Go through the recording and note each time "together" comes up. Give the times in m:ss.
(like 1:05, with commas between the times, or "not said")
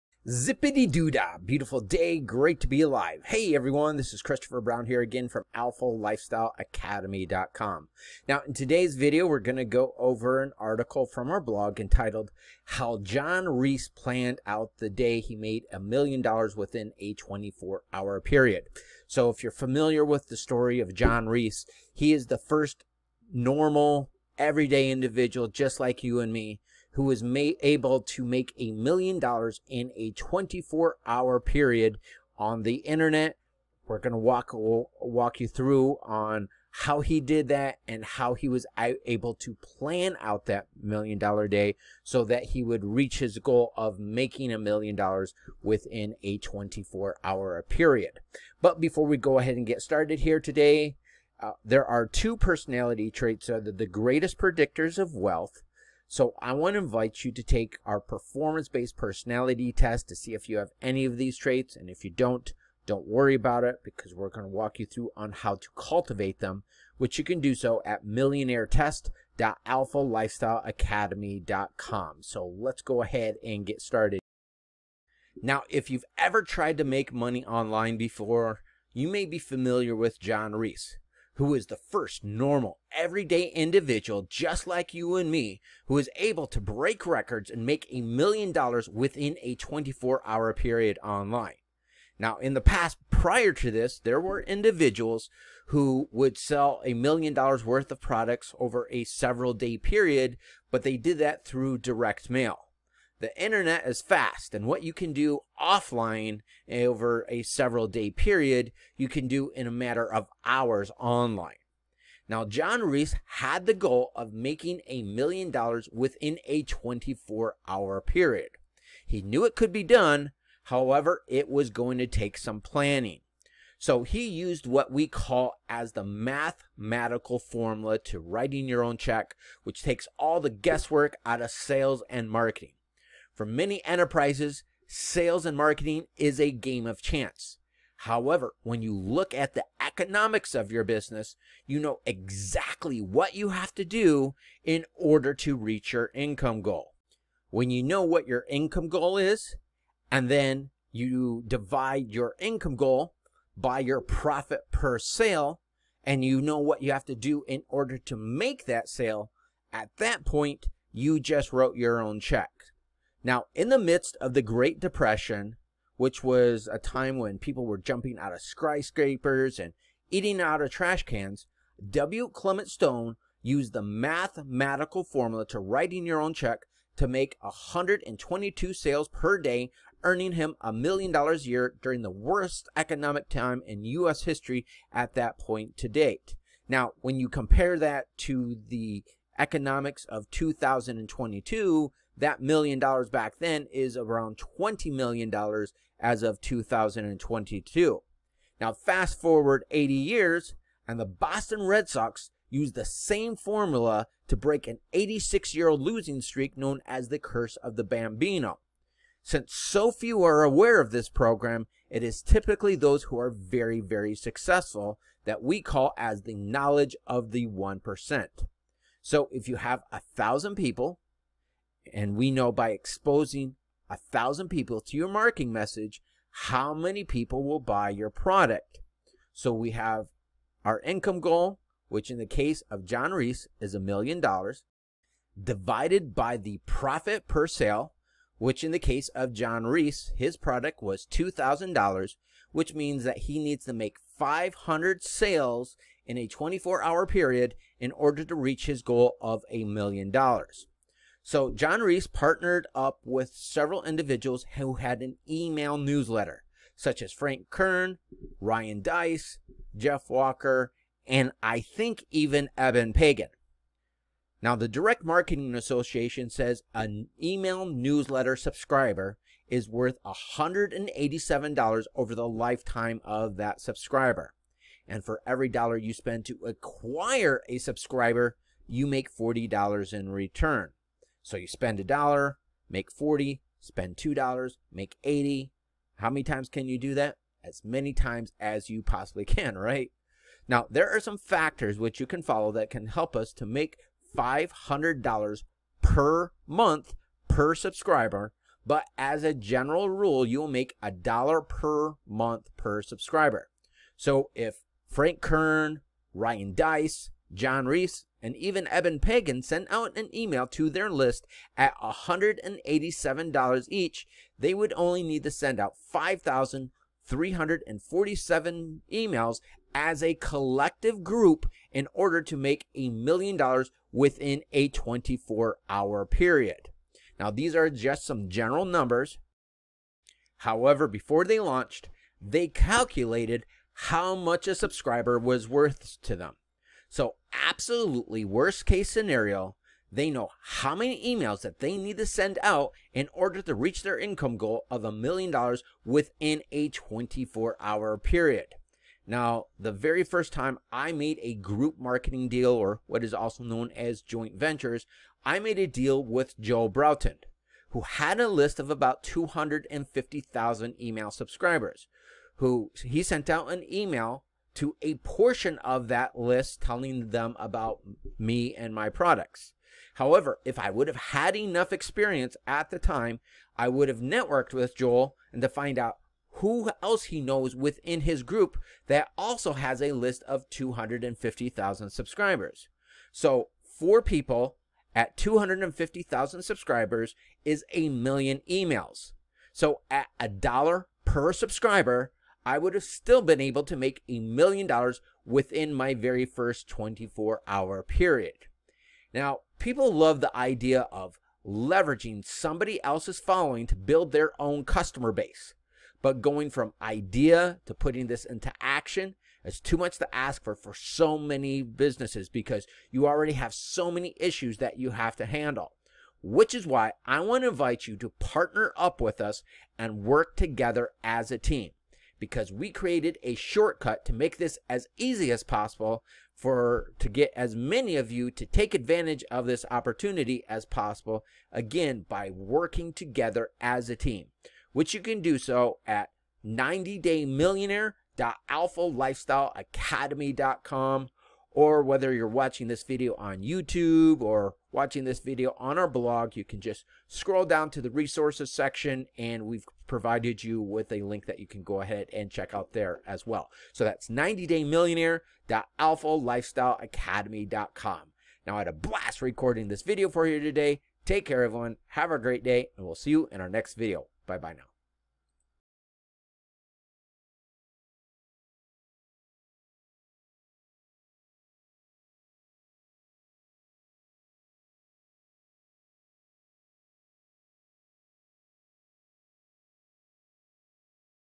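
7:00, 7:12.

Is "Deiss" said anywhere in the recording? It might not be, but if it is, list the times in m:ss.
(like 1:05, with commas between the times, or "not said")
4:18, 5:06.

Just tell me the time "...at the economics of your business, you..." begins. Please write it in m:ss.
2:19.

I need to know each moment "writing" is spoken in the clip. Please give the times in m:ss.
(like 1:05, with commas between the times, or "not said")
2:08, 2:55.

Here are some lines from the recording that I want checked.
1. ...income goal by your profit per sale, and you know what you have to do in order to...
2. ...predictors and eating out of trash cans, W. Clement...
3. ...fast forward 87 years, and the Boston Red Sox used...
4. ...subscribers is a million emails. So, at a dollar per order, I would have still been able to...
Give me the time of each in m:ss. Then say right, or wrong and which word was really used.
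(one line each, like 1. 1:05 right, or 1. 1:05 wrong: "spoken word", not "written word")
1. 2:32 right
2. 2:48 wrong: "skyscrapers", not "predictors"
3. 3:18 wrong: "80", not "87"
4. 6:26 wrong: "subscriber", not "order".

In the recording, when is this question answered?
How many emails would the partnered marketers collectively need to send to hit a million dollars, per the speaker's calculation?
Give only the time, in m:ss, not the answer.
5:15.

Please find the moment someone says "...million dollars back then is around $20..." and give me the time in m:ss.
3:12.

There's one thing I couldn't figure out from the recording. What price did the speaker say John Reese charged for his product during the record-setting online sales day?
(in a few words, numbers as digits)
$2,000.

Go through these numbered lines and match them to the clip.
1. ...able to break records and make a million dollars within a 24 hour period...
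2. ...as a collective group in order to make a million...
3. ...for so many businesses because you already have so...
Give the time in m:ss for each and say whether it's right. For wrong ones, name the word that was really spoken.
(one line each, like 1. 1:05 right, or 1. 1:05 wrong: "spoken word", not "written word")
1. 1:26 right
2. 5:19 right
3. 6:50 right.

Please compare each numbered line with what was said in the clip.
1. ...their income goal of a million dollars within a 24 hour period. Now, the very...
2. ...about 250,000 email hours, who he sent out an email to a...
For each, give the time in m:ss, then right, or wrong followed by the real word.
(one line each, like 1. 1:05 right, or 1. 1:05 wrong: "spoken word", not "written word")
1. 5:43 right
2. 5:58 wrong: "subscribers", not "hours".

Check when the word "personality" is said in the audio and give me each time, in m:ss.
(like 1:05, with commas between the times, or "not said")
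0:52, 0:58.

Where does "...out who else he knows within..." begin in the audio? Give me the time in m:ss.
6:15.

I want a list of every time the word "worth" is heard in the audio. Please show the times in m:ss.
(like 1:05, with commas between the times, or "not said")
1:37, 4:29, 5:35.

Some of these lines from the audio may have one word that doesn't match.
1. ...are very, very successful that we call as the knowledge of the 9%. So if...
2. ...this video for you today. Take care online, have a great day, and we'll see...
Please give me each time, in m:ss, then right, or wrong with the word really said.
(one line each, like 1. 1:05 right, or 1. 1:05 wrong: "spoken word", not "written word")
1. 3:33 wrong: "1", not "9"
2. 7:39 wrong: "everyone", not "online".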